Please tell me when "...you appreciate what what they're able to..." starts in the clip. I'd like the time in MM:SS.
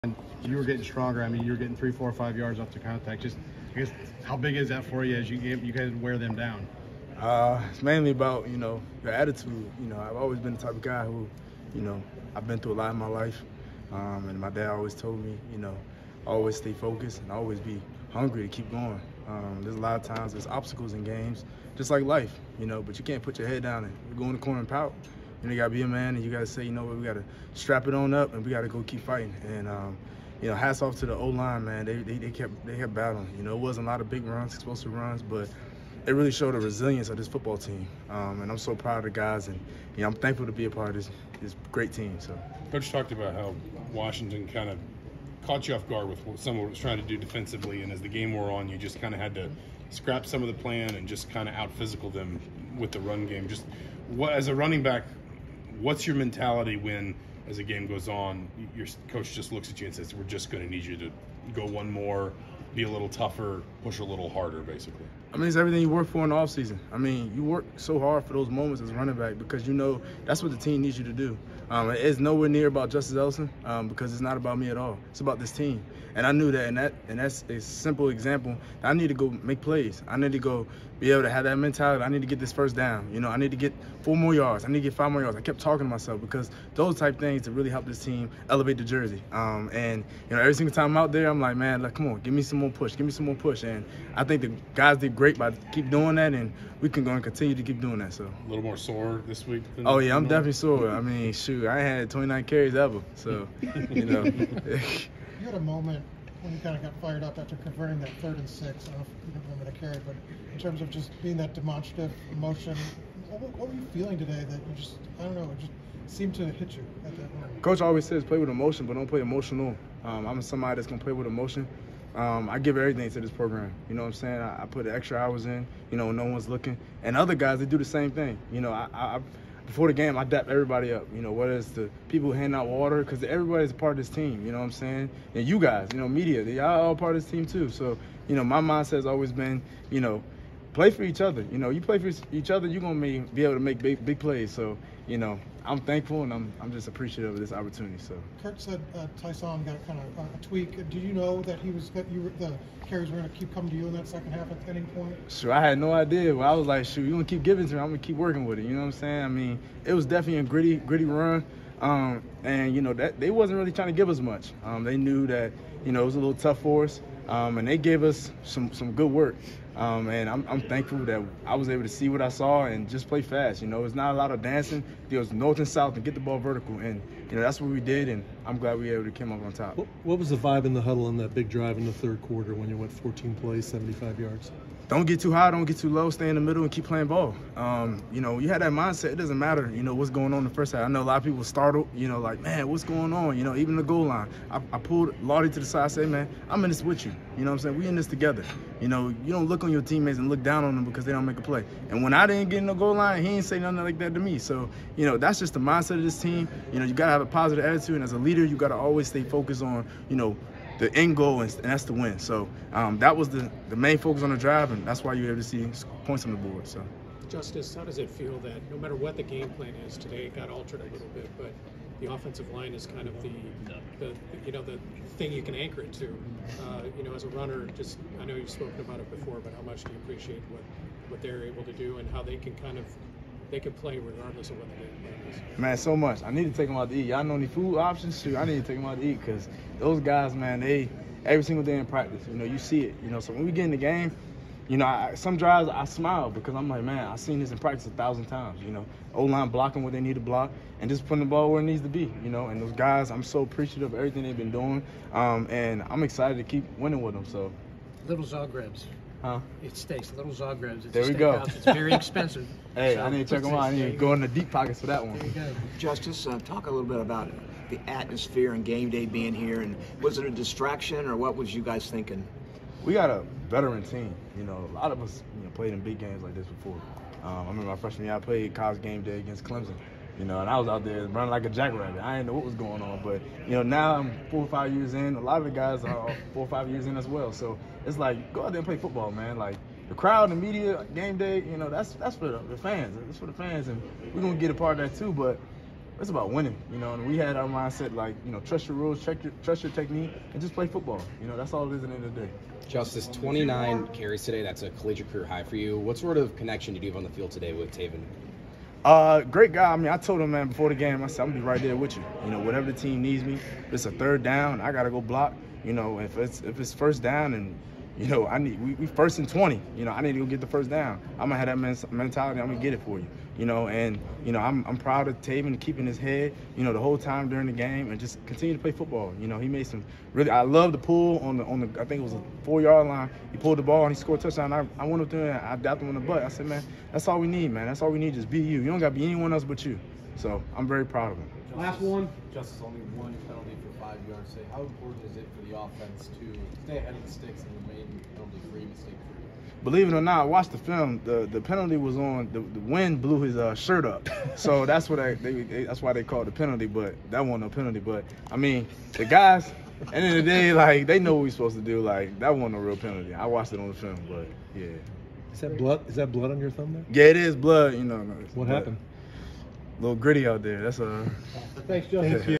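03:49.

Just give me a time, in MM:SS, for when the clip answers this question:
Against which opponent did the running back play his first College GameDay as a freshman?
04:39.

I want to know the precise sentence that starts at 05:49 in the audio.
Believe it or not, watch the film.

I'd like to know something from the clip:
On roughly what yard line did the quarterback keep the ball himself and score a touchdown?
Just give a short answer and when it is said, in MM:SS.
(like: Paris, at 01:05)
4, at 05:32.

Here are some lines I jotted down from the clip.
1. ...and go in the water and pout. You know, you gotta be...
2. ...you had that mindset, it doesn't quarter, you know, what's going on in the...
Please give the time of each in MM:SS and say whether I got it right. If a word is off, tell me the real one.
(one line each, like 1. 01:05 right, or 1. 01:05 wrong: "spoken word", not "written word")
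1. 00:23 wrong: "corner", not "water"
2. 03:08 wrong: "matter", not "quarter".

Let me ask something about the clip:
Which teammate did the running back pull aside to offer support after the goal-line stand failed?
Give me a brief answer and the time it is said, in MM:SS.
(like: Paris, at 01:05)
Lottie, at 03:15.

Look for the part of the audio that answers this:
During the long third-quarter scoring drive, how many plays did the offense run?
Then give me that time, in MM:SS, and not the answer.
03:02.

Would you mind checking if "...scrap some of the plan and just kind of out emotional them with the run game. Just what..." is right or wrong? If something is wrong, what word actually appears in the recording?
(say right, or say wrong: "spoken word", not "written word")
wrong: "physical", not "emotional".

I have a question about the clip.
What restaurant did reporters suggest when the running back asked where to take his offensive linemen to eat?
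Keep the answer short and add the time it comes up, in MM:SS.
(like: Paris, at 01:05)
Zagreb's, at 04:20.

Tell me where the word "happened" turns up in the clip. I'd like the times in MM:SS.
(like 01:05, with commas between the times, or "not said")
06:08.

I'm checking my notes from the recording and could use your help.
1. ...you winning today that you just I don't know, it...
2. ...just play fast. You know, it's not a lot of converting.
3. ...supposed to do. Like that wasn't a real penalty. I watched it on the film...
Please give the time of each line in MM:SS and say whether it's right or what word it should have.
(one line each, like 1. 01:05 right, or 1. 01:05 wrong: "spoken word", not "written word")
1. 01:53 wrong: "feeling", not "winning"
2. 02:52 wrong: "dancing", not "converting"
3. 06:01 right.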